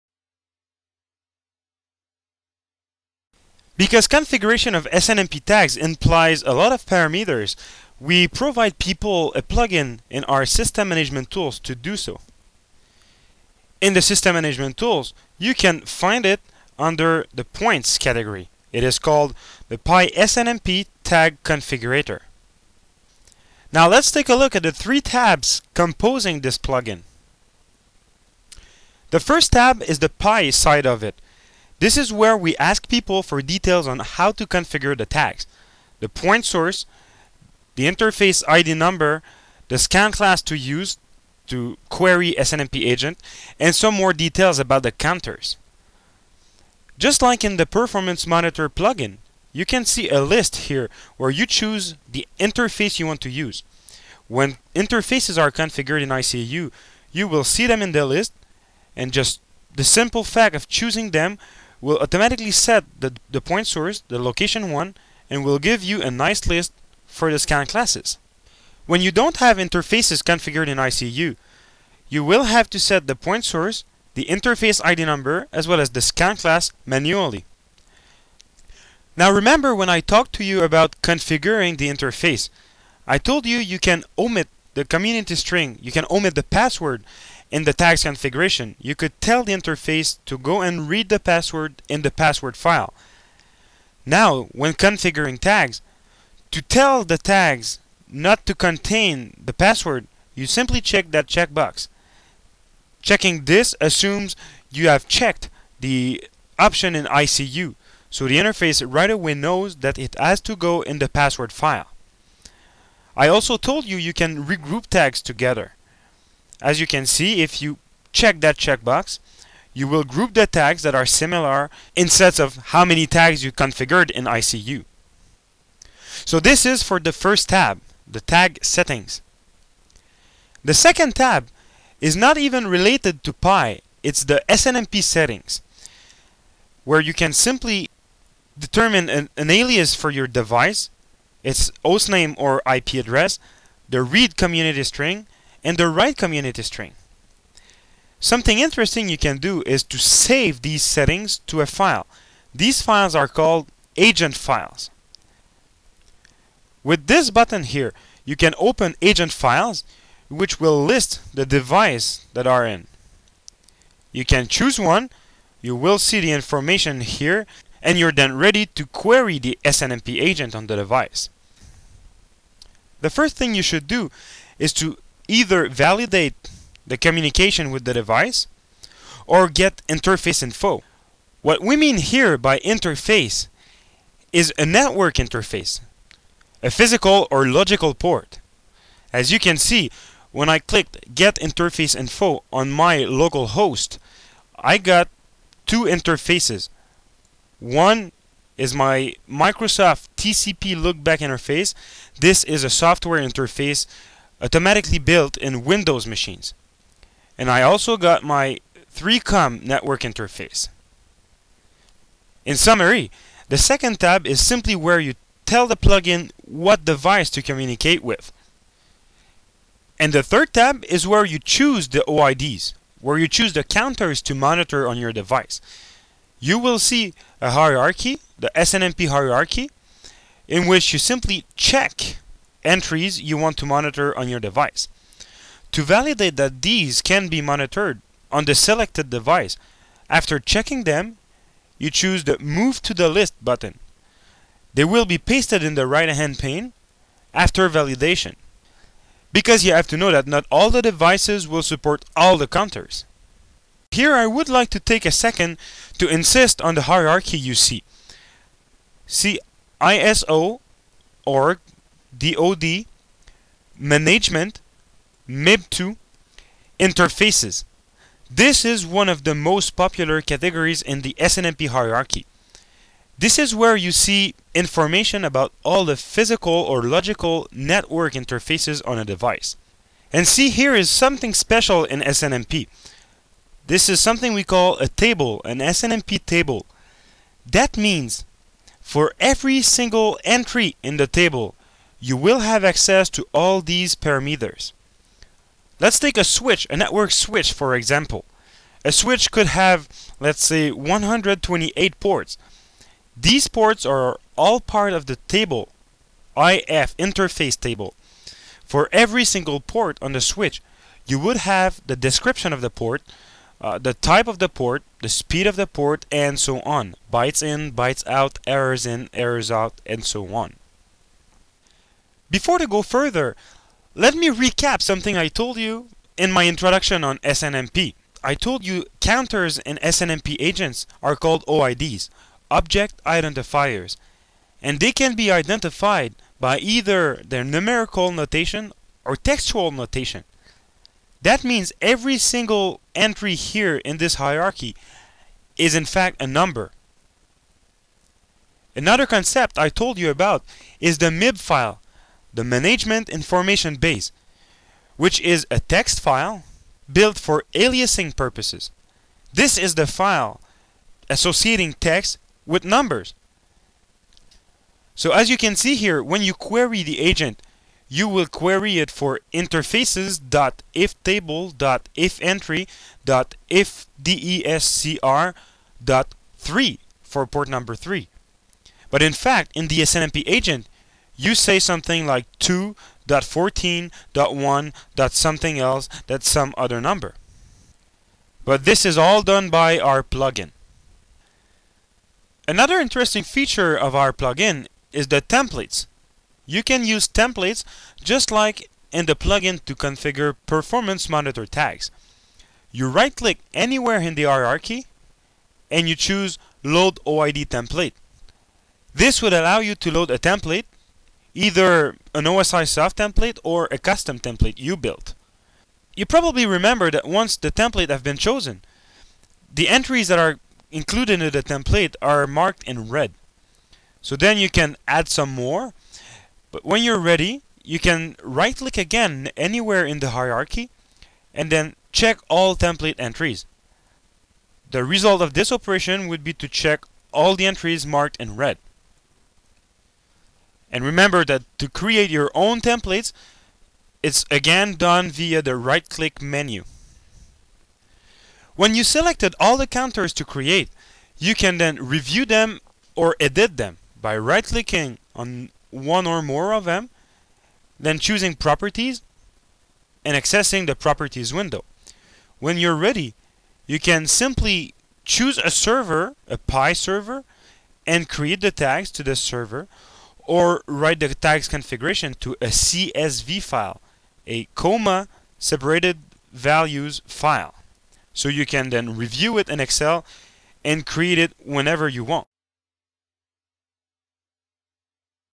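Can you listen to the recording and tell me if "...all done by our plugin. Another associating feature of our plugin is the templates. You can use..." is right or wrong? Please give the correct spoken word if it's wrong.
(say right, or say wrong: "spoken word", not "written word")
wrong: "interesting", not "associating".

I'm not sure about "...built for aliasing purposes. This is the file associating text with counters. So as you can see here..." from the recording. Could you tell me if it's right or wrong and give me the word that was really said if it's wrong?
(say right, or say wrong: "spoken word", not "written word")
wrong: "numbers", not "counters".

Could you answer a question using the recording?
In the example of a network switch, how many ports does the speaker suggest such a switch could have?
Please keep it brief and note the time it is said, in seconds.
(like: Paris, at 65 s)
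128, at 300 s.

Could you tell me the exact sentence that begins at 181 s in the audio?
What we mean here by interface is a network interface, a physical or logical port.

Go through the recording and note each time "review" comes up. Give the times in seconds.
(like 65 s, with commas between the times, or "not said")
451 s, 478 s.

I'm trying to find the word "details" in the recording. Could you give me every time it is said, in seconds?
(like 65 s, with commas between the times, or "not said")
33 s, 44 s.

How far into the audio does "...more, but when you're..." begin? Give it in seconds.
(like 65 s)
425 s.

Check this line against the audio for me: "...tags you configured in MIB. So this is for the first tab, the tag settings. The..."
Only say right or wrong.
wrong.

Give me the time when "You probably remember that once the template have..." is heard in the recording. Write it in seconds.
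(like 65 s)
415 s.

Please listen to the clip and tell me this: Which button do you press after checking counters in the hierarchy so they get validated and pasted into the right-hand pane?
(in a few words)
Move to the List.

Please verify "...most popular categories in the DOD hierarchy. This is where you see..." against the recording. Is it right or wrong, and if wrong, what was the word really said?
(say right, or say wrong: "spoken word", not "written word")
wrong: "SNMP", not "DOD".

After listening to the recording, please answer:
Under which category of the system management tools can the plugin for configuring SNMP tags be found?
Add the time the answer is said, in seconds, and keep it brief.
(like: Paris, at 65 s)
points, at 17 s.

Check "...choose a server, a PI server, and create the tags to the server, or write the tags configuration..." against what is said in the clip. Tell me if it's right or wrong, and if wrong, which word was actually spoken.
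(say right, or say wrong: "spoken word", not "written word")
right.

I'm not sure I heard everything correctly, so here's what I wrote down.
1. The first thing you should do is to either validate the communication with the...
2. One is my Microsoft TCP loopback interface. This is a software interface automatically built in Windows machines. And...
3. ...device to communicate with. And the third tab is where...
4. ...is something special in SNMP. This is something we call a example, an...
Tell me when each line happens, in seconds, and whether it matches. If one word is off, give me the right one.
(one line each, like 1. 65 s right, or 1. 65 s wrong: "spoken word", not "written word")
1. 173 s right
2. 197 s right
3. 216 s right
4. 280 s wrong: "table", not "example".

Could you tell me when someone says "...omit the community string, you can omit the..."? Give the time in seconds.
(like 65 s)
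84 s.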